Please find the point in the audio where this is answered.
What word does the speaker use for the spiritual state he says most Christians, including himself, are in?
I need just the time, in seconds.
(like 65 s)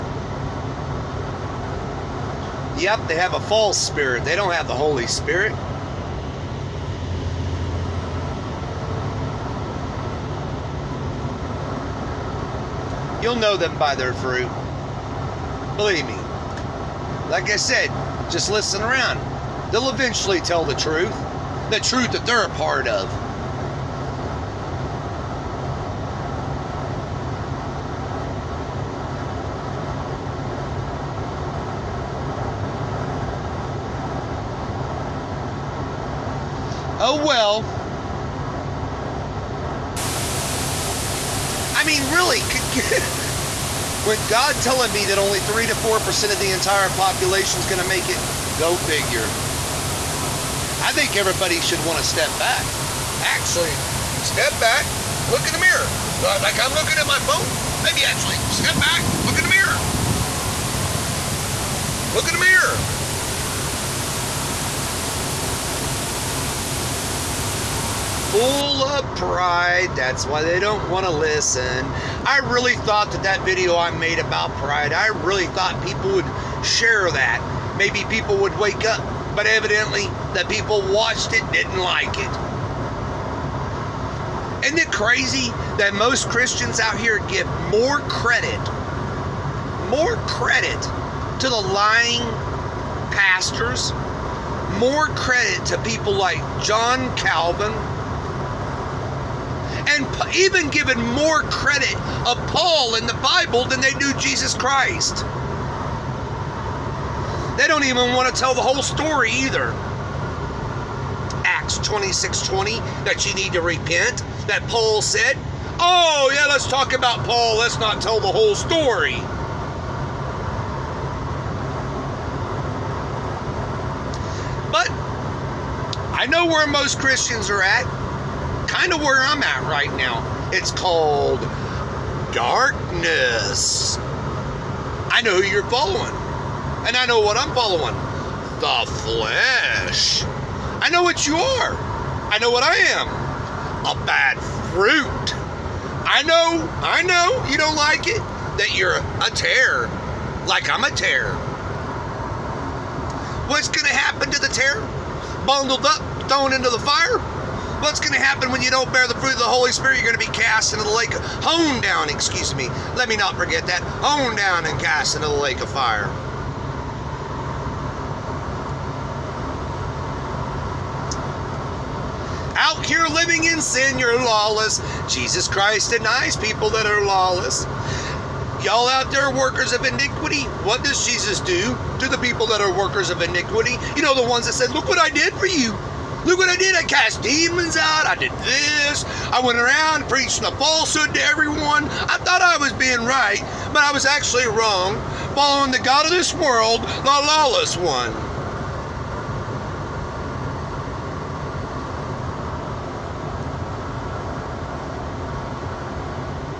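132 s.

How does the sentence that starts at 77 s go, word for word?
Maybe people would wake up, but evidently the people watched it didn't like it.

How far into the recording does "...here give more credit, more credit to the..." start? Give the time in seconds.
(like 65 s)
87 s.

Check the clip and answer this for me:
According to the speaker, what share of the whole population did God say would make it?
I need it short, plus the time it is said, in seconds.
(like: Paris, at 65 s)
3 to 4%, at 45 s.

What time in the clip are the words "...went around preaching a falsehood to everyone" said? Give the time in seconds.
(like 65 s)
189 s.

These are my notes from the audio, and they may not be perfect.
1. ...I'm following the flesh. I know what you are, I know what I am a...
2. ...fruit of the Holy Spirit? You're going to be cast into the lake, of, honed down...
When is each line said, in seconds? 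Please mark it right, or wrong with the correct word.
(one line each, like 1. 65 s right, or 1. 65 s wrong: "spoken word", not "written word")
1. 137 s right
2. 159 s right.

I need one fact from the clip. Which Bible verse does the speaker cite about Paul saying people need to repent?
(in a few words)
Acts 26:20.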